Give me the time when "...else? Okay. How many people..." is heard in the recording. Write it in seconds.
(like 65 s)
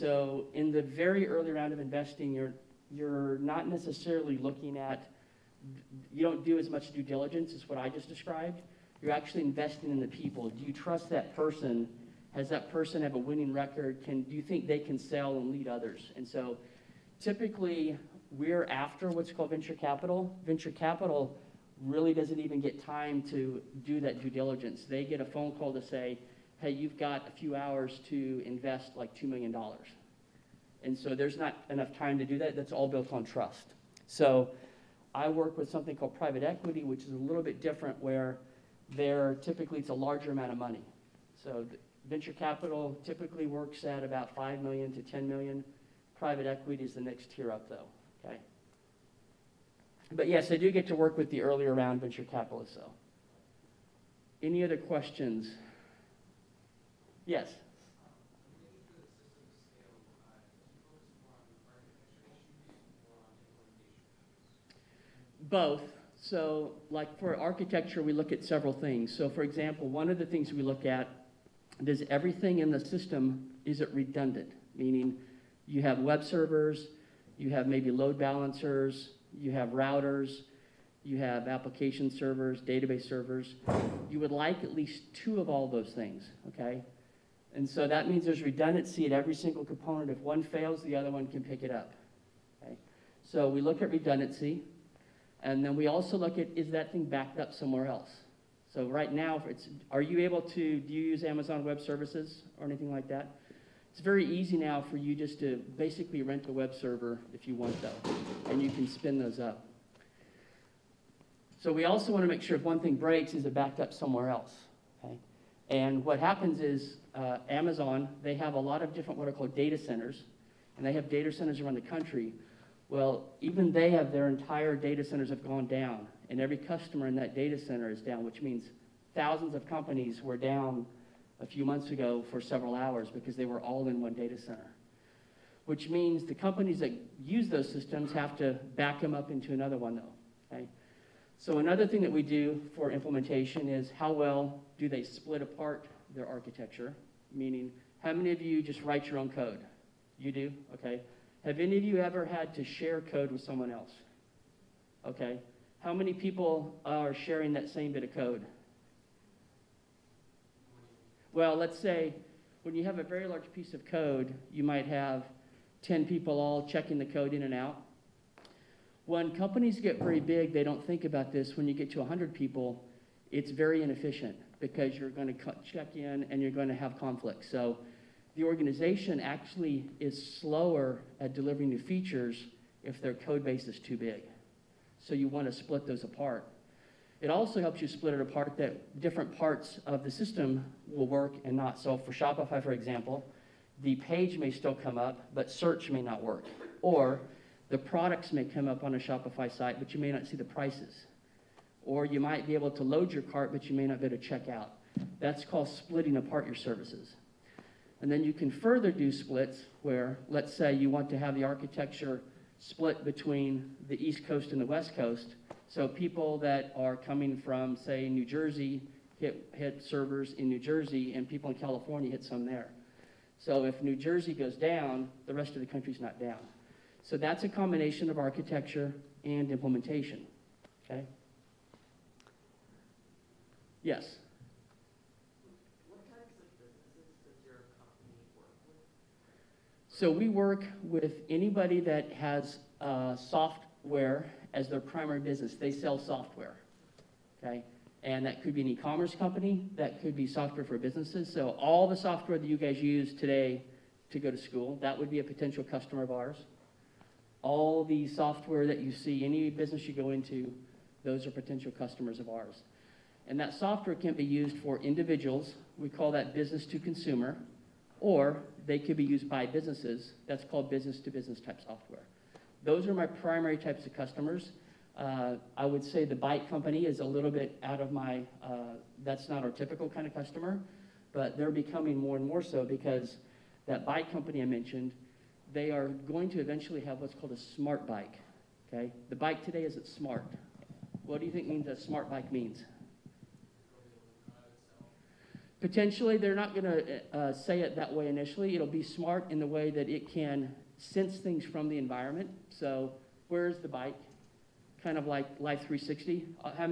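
153 s.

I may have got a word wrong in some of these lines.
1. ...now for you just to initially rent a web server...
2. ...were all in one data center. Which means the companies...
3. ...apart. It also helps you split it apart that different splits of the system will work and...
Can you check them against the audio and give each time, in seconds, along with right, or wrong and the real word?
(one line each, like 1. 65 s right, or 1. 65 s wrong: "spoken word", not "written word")
1. 104 s wrong: "basically", not "initially"
2. 133 s right
3. 186 s wrong: "parts", not "splits".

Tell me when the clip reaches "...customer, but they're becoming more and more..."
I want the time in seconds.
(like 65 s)
280 s.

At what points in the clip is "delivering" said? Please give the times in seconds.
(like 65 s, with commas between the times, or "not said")
181 s.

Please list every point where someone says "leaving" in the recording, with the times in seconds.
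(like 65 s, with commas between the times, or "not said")
not said.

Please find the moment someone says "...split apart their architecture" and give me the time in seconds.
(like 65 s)
145 s.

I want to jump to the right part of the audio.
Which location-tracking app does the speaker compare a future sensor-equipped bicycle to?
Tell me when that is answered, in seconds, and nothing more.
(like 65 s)
305 s.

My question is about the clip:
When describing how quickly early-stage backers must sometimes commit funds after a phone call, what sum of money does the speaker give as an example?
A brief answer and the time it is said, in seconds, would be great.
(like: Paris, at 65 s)
$2 million, at 29 s.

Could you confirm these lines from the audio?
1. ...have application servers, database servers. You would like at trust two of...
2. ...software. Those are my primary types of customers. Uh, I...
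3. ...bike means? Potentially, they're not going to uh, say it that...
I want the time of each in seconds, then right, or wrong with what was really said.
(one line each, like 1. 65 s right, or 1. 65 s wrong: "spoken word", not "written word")
1. 81 s wrong: "least", not "trust"
2. 271 s right
3. 292 s right.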